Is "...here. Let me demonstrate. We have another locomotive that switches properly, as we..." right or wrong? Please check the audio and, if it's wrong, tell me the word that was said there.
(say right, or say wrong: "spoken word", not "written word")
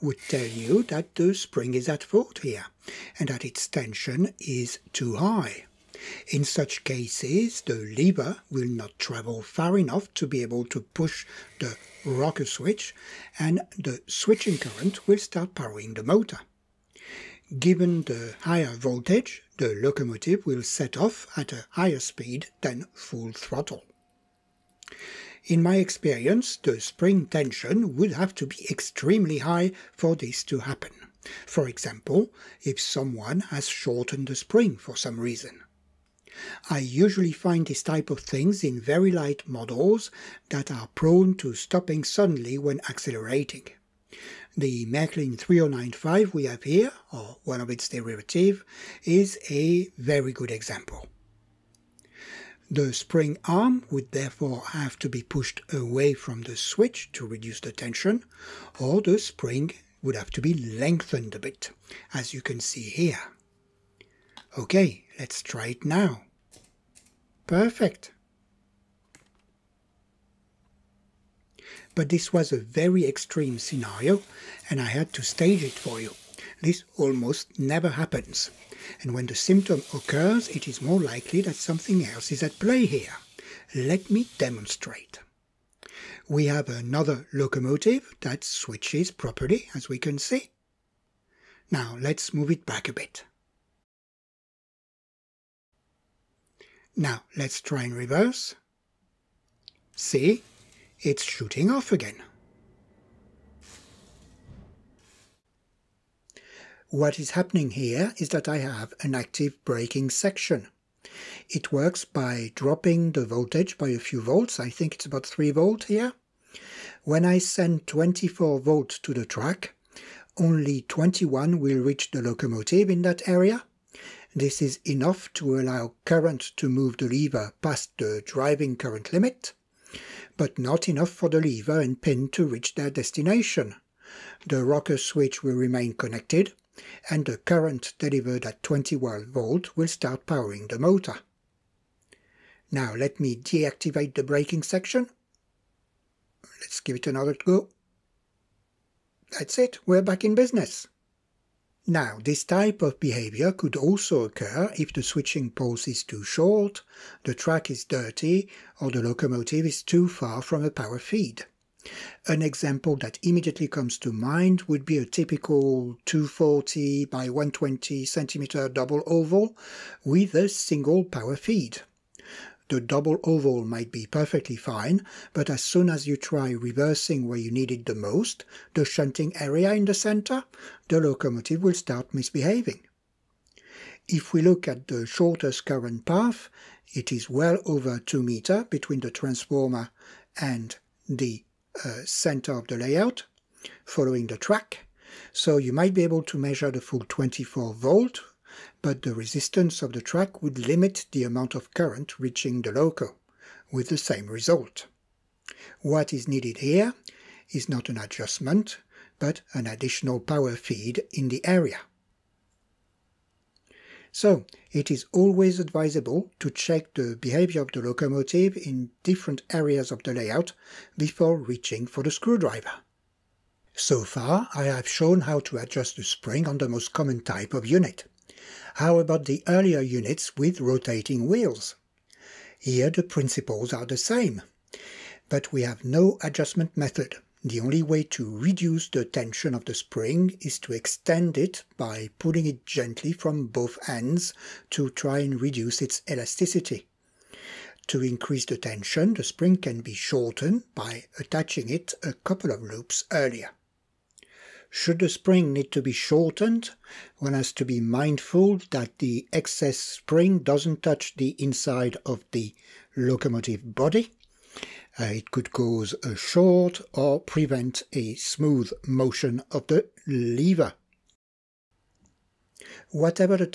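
right.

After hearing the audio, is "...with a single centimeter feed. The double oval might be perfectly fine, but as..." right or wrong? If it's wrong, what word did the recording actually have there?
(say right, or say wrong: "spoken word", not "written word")
wrong: "power", not "centimeter".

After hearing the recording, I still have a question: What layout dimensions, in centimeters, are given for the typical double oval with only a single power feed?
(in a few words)
240 by 120.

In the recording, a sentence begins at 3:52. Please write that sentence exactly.
Here the principles are the same, but we have no adjustment method.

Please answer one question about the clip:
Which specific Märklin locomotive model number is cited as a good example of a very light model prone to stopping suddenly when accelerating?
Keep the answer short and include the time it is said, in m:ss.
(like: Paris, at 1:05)
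3095, at 0:45.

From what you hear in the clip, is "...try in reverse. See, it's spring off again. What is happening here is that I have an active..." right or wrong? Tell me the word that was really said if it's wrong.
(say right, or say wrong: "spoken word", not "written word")
wrong: "shooting", not "spring".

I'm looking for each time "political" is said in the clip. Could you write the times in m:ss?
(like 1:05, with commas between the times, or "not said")
not said.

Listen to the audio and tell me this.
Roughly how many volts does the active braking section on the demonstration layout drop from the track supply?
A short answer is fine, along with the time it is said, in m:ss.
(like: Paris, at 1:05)
3 volts, at 1:55.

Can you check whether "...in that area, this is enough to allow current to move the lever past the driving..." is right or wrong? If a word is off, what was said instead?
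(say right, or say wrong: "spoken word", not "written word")
right.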